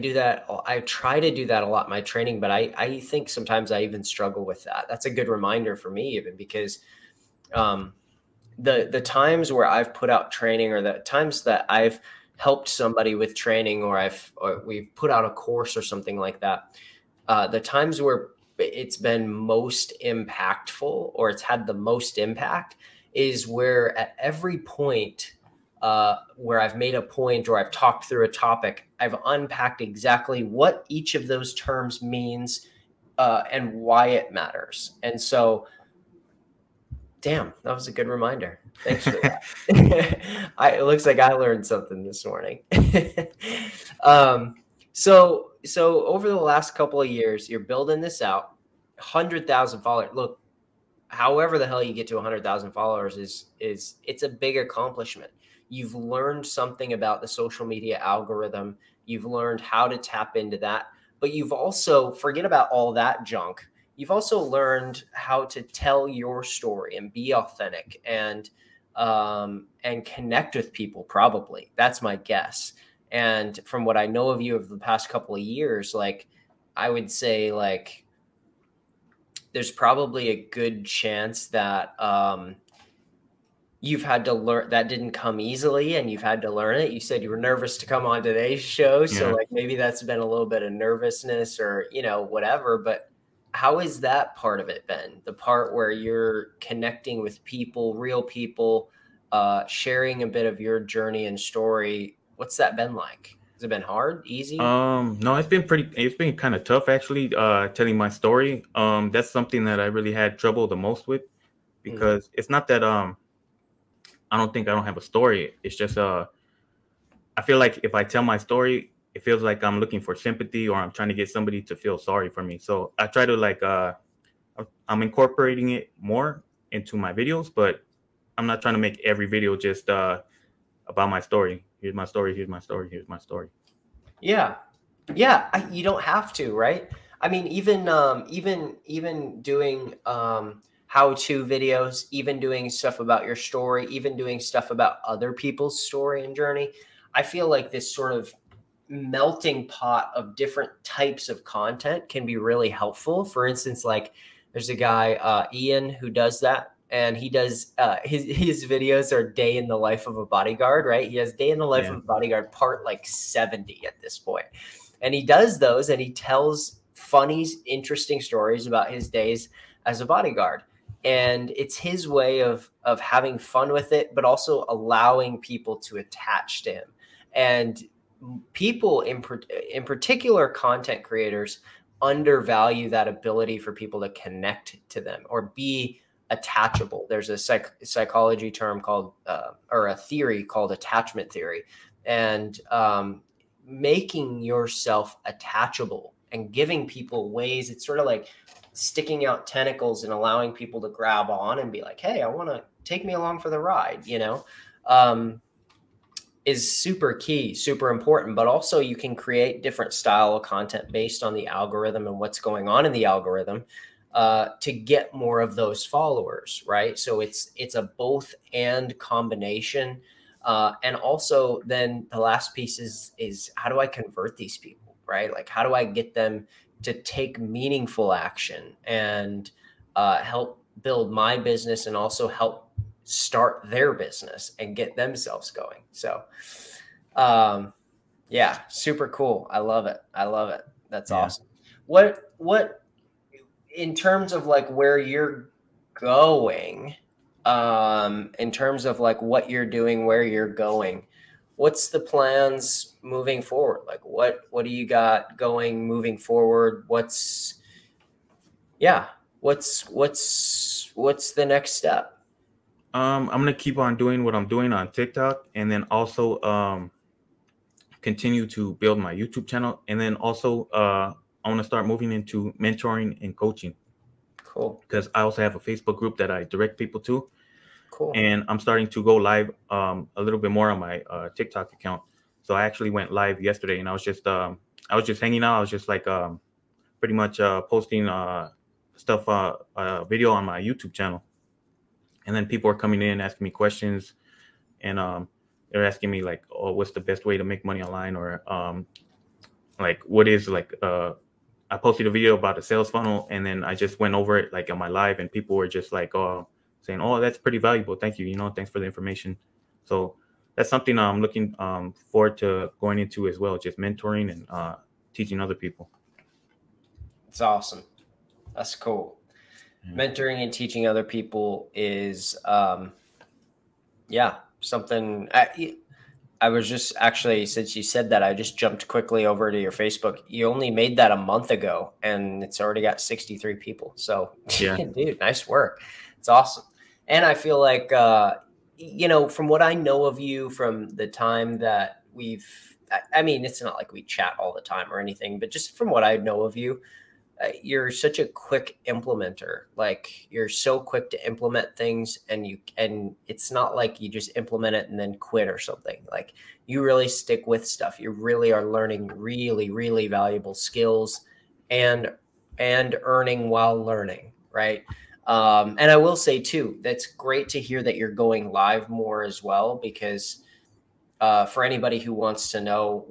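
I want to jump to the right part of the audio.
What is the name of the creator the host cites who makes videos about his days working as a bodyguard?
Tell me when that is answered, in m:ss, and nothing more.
2:35.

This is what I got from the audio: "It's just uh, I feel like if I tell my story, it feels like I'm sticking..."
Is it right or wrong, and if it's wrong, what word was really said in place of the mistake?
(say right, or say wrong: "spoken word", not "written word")
wrong: "looking", not "sticking".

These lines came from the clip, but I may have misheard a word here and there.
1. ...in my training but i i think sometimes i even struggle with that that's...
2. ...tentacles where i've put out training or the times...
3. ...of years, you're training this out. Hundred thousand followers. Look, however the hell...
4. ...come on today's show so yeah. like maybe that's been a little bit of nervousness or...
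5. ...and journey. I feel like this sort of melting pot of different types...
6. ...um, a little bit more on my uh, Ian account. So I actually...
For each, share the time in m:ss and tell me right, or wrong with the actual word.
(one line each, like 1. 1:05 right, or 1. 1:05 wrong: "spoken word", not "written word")
1. 0:01 right
2. 0:09 wrong: "times", not "tentacles"
3. 0:47 wrong: "building", not "training"
4. 1:27 right
5. 2:26 right
6. 4:39 wrong: "TikTok", not "Ian".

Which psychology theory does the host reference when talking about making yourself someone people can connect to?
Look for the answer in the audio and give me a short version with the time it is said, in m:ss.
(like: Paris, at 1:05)
Attachment theory, at 3:10.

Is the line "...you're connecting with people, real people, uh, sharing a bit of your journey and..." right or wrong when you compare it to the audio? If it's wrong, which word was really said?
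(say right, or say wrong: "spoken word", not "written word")
right.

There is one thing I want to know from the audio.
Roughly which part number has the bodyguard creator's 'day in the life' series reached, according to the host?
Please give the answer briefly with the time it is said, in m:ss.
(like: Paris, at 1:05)
70, at 2:43.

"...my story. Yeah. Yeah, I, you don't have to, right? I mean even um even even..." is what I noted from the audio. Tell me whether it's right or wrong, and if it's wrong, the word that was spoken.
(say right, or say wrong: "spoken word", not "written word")
right.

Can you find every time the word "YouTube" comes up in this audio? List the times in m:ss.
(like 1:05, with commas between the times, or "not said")
4:29, 4:50.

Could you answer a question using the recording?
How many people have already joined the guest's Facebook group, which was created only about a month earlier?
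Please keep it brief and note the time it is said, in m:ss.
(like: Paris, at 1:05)
63, at 5:32.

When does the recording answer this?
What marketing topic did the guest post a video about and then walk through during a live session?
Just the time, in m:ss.
5:02.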